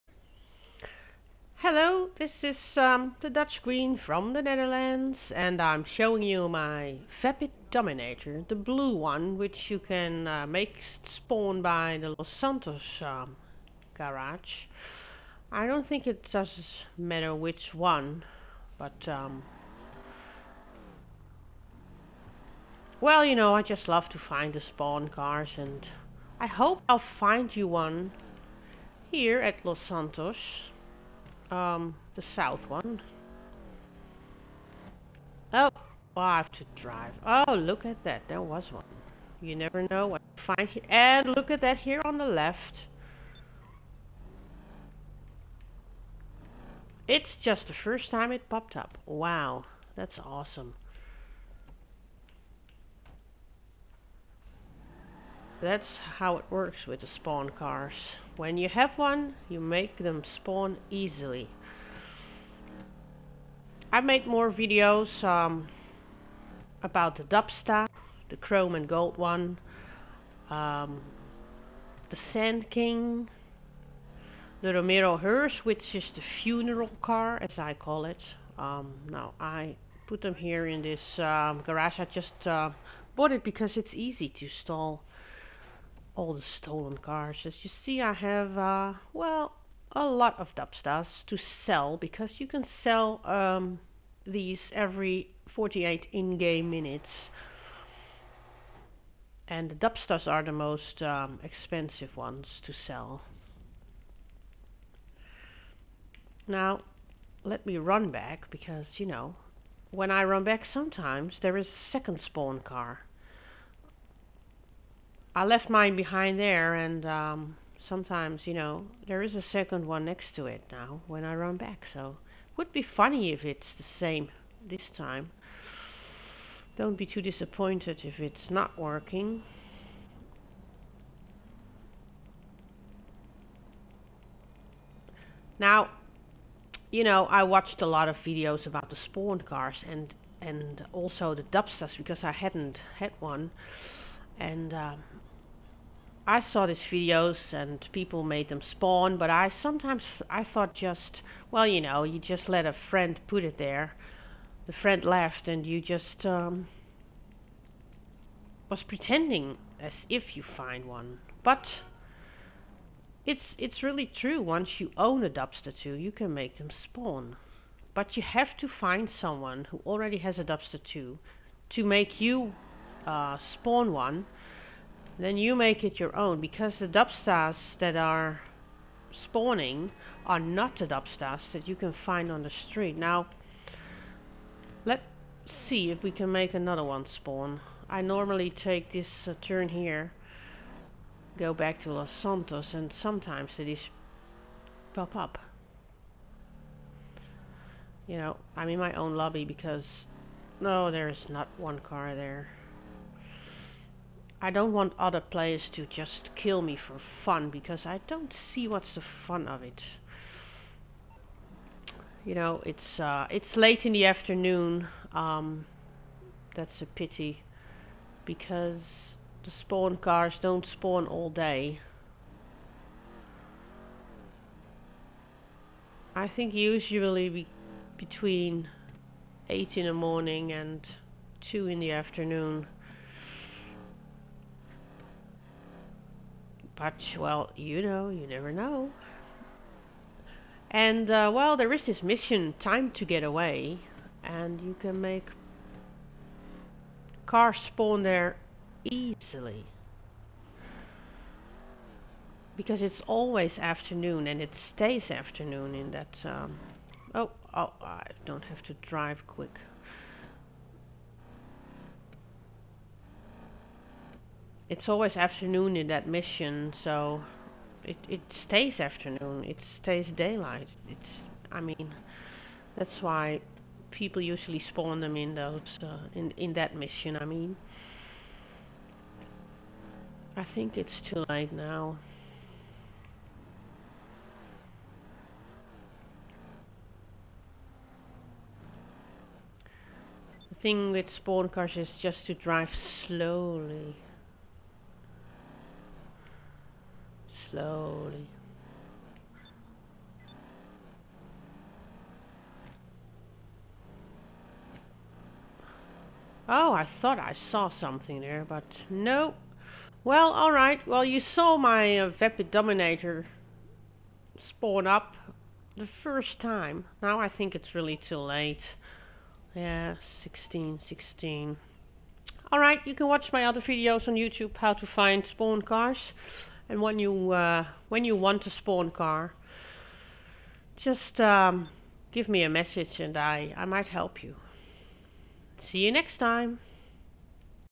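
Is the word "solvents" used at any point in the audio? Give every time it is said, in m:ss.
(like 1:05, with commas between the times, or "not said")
not said.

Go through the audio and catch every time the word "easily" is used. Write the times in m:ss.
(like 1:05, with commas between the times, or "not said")
1:00, 4:08.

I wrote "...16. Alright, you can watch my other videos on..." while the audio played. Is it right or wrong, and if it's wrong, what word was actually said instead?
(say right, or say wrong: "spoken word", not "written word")
right.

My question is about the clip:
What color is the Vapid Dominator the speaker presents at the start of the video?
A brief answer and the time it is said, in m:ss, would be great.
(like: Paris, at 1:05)
Blue, at 0:08.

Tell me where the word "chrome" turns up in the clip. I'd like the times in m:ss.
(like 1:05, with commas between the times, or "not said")
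1:08.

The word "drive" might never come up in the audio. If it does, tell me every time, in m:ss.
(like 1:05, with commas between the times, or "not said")
0:36, 4:18, 4:52.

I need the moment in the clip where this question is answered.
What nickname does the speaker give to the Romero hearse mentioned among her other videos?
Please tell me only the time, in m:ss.
1:16.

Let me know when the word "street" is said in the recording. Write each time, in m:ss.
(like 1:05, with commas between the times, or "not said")
3:02.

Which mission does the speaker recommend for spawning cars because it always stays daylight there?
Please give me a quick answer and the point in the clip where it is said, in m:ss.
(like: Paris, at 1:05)
Time to Get Away, at 4:02.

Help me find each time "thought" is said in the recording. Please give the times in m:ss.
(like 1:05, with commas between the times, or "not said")
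2:30, 5:06.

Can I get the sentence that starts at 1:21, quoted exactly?
I just uh, bought it because it's easy to install all the stolen cars.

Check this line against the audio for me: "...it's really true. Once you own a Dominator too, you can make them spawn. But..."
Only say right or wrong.
wrong.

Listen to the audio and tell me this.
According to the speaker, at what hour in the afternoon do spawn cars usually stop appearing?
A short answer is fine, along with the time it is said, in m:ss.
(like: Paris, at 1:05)
2 in the afternoon, at 3:51.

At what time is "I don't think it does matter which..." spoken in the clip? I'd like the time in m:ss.
0:15.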